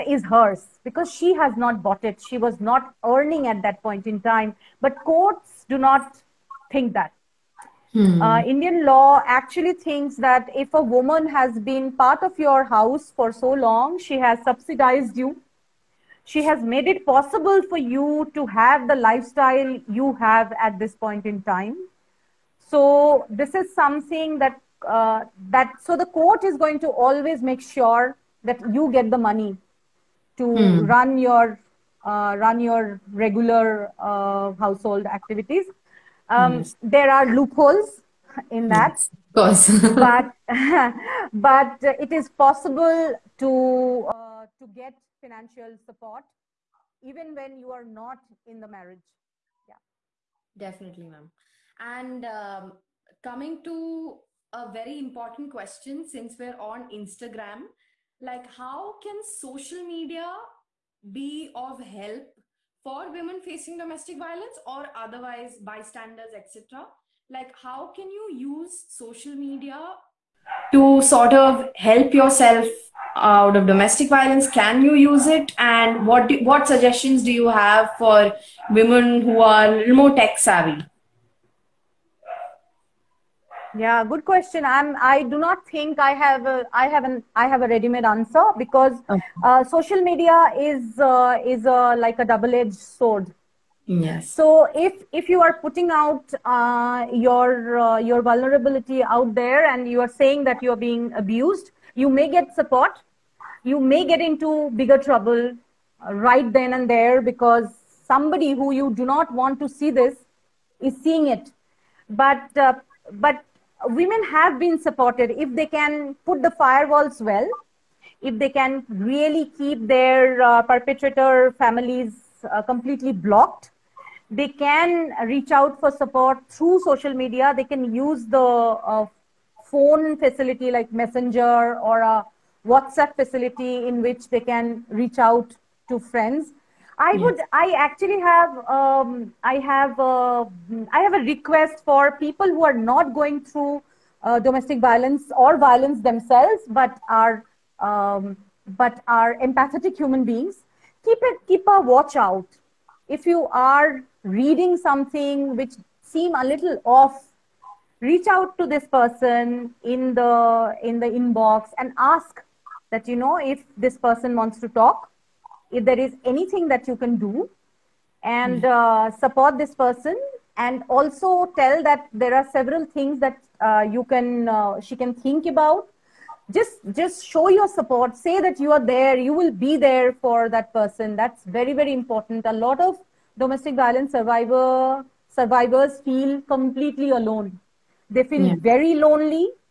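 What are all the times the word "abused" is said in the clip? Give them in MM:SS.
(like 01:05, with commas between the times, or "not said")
01:41.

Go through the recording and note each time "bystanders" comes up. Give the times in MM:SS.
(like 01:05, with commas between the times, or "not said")
01:05.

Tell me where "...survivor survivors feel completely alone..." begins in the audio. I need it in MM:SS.
03:04.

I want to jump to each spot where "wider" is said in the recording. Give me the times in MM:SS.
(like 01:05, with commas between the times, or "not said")
not said.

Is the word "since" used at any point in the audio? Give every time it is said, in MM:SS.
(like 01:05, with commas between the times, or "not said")
00:56.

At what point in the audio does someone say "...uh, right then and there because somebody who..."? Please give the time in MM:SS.
01:45.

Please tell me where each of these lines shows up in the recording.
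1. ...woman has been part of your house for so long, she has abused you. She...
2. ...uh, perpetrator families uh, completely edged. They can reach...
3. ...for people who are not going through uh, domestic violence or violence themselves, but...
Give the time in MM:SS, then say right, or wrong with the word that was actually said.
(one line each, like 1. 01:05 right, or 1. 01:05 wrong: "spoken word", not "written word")
1. 00:10 wrong: "subsidized", not "abused"
2. 02:00 wrong: "blocked", not "edged"
3. 02:21 right.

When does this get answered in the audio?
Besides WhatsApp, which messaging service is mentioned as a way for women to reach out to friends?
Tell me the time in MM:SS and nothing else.
02:10.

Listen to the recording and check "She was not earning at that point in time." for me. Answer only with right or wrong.
right.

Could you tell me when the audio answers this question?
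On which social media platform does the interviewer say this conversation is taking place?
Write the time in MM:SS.
00:56.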